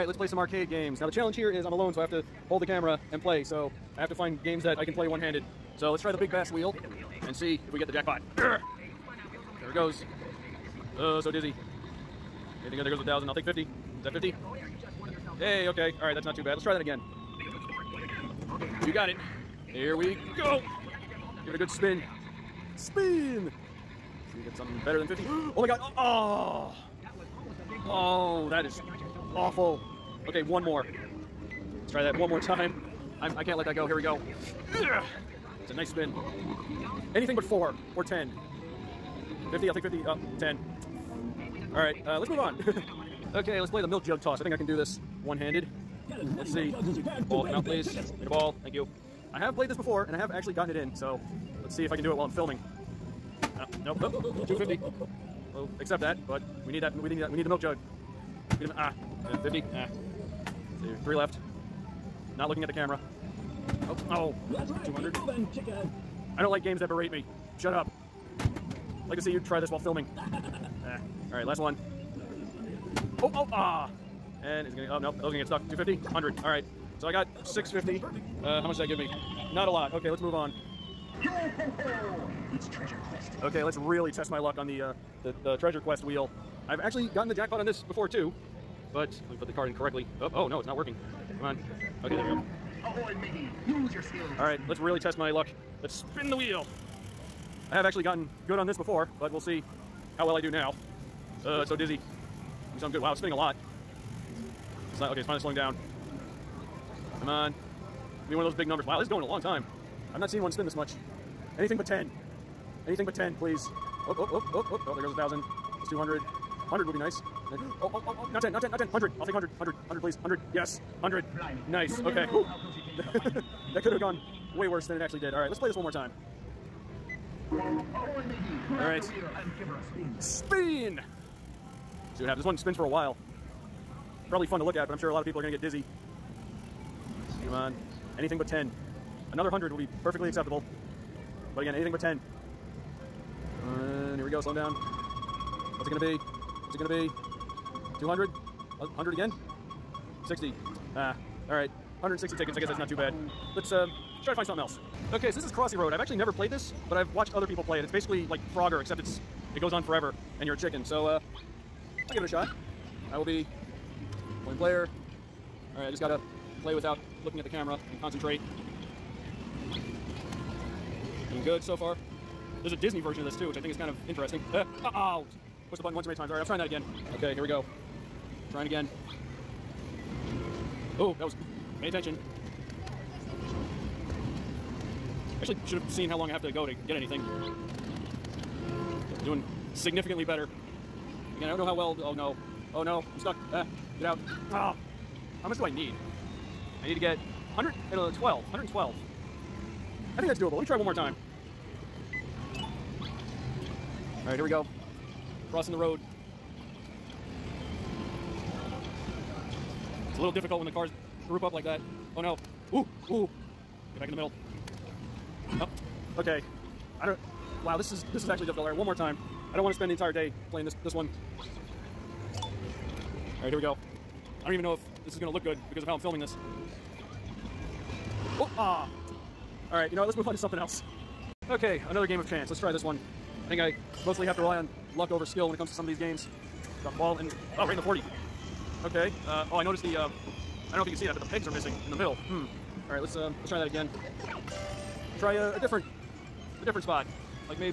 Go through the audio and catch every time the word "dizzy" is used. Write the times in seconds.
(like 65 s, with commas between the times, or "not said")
11 s, 101 s, 135 s.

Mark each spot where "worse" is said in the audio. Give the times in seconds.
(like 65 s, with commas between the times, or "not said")
124 s.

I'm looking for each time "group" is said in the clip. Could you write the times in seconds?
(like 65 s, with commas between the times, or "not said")
211 s.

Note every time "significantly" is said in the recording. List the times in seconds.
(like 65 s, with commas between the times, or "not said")
189 s.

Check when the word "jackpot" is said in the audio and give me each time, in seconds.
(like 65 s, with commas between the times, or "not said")
7 s, 87 s.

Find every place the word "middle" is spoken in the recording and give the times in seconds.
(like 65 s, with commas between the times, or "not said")
214 s, 241 s.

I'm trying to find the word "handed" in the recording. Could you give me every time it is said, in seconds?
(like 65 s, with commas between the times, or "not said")
5 s, 45 s.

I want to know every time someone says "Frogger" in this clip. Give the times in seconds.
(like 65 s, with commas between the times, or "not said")
158 s.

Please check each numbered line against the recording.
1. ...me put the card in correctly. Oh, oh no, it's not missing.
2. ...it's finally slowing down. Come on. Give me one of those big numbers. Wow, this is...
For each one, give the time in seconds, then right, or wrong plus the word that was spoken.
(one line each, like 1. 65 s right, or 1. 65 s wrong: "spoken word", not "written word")
1. 89 s wrong: "working", not "missing"
2. 105 s right.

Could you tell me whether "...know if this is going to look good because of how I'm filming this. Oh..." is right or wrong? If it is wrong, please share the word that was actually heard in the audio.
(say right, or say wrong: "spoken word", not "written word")
right.